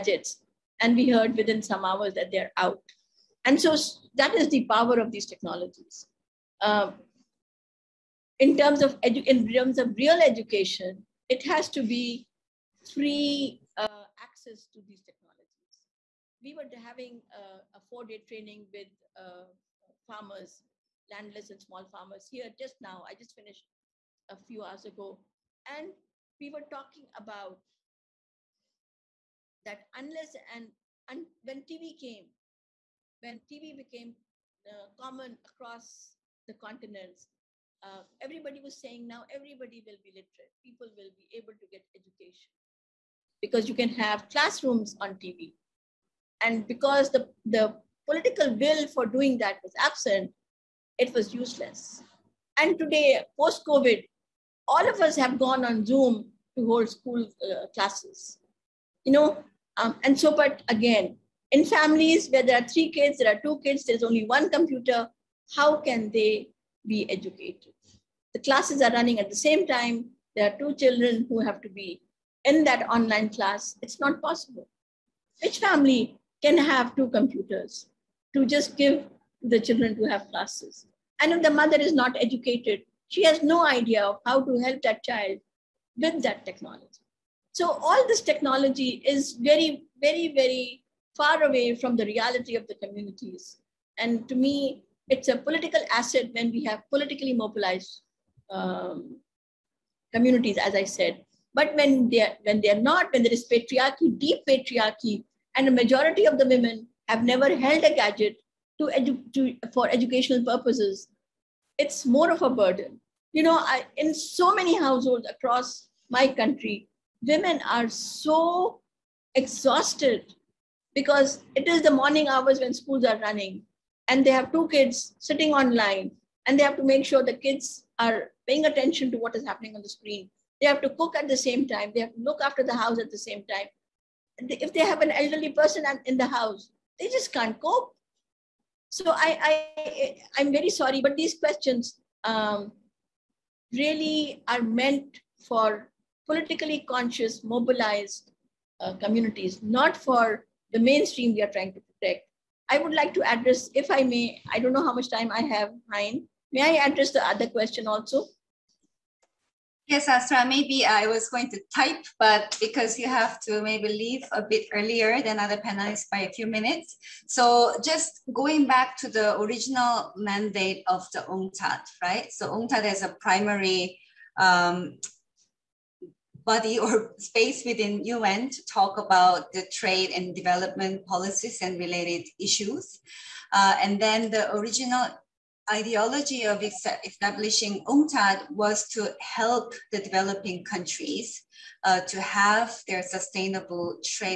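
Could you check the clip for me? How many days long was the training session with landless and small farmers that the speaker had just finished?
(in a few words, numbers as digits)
4.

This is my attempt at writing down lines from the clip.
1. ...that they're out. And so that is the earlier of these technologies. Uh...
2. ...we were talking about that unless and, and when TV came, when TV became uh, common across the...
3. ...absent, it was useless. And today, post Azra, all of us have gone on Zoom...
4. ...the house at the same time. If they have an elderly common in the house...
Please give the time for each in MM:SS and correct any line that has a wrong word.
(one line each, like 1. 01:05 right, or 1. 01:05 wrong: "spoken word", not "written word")
1. 00:02 wrong: "power", not "earlier"
2. 00:26 right
3. 00:49 wrong: "COVID", not "Azra"
4. 02:12 wrong: "person", not "common".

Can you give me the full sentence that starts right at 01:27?
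So all this technology is very, very, very far away from the reality of the communities.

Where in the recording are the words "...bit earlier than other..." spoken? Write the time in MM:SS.
02:44.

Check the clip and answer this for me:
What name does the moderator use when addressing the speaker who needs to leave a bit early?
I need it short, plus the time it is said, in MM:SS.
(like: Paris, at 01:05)
Azra, at 02:40.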